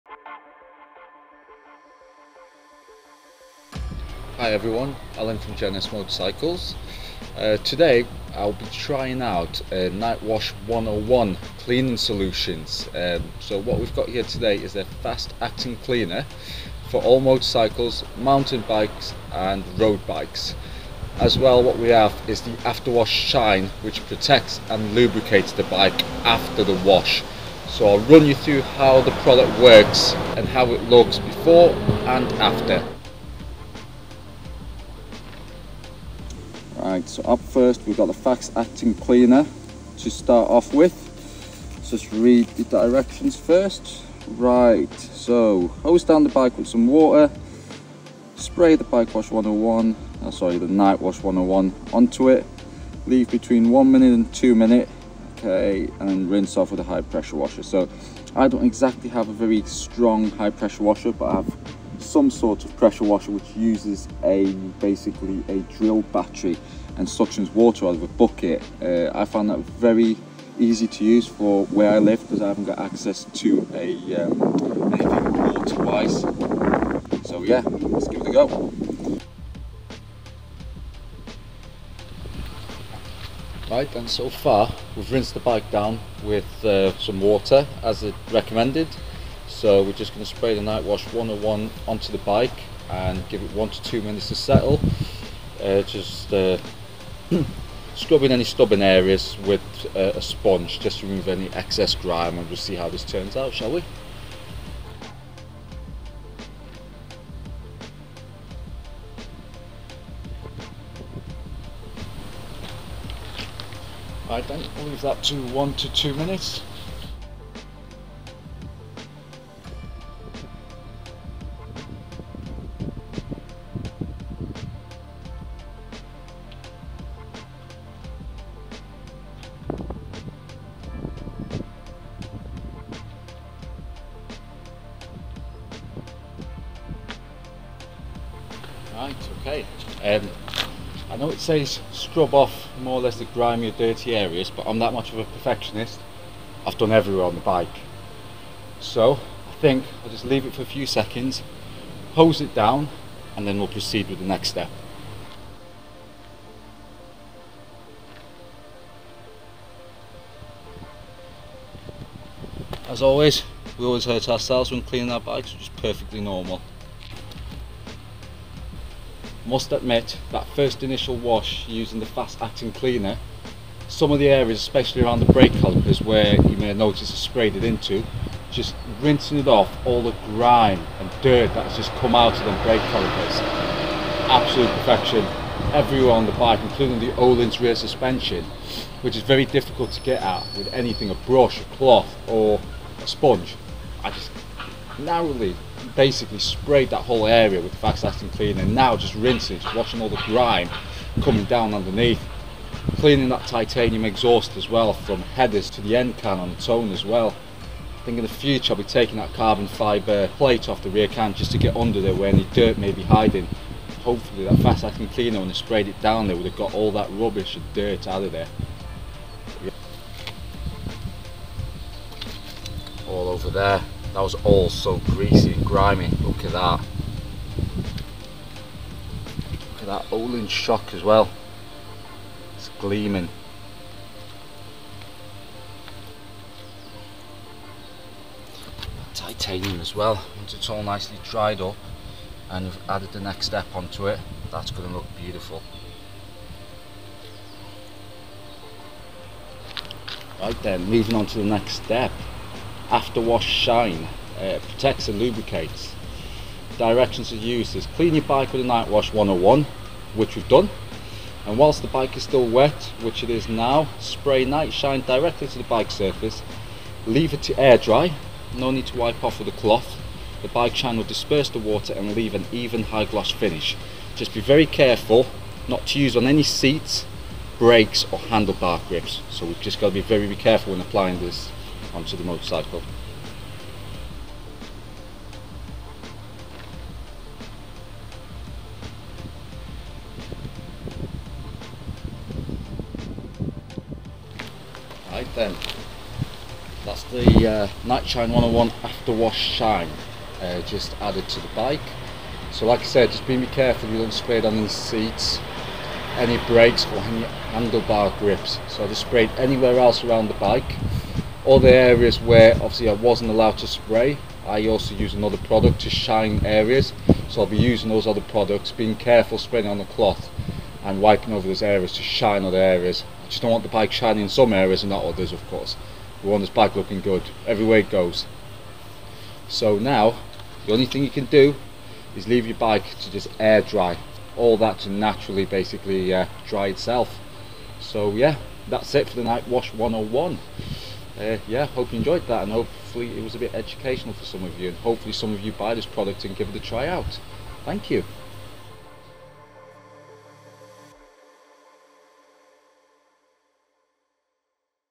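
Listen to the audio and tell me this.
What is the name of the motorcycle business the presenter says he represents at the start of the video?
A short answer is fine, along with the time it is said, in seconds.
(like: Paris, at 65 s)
J&S Motorcycles, at 5 s.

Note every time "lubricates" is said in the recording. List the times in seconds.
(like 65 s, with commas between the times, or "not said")
24 s, 255 s.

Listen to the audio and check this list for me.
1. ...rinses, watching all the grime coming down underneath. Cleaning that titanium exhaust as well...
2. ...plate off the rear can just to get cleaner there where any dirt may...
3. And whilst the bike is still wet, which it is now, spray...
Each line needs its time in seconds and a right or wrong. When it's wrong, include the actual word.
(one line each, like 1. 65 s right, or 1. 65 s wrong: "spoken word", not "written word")
1. 199 s right
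2. 210 s wrong: "under", not "cleaner"
3. 261 s right.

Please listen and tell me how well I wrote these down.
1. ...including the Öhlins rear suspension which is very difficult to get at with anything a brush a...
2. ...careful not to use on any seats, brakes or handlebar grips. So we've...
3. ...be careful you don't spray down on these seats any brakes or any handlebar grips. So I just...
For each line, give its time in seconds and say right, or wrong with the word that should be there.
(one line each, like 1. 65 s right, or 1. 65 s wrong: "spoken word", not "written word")
1. 186 s right
2. 274 s right
3. 303 s right.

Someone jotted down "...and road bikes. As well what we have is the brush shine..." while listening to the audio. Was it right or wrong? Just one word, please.
wrong.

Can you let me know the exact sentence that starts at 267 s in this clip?
Leave it to air dry, no need to wipe off with a cloth.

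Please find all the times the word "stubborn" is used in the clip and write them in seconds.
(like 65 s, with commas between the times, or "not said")
98 s.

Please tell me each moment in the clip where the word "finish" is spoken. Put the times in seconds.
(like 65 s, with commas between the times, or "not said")
273 s.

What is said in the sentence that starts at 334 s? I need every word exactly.
All that to naturally basically uh, dry itself.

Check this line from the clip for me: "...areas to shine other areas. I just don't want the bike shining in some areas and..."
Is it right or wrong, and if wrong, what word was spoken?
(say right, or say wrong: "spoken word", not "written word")
right.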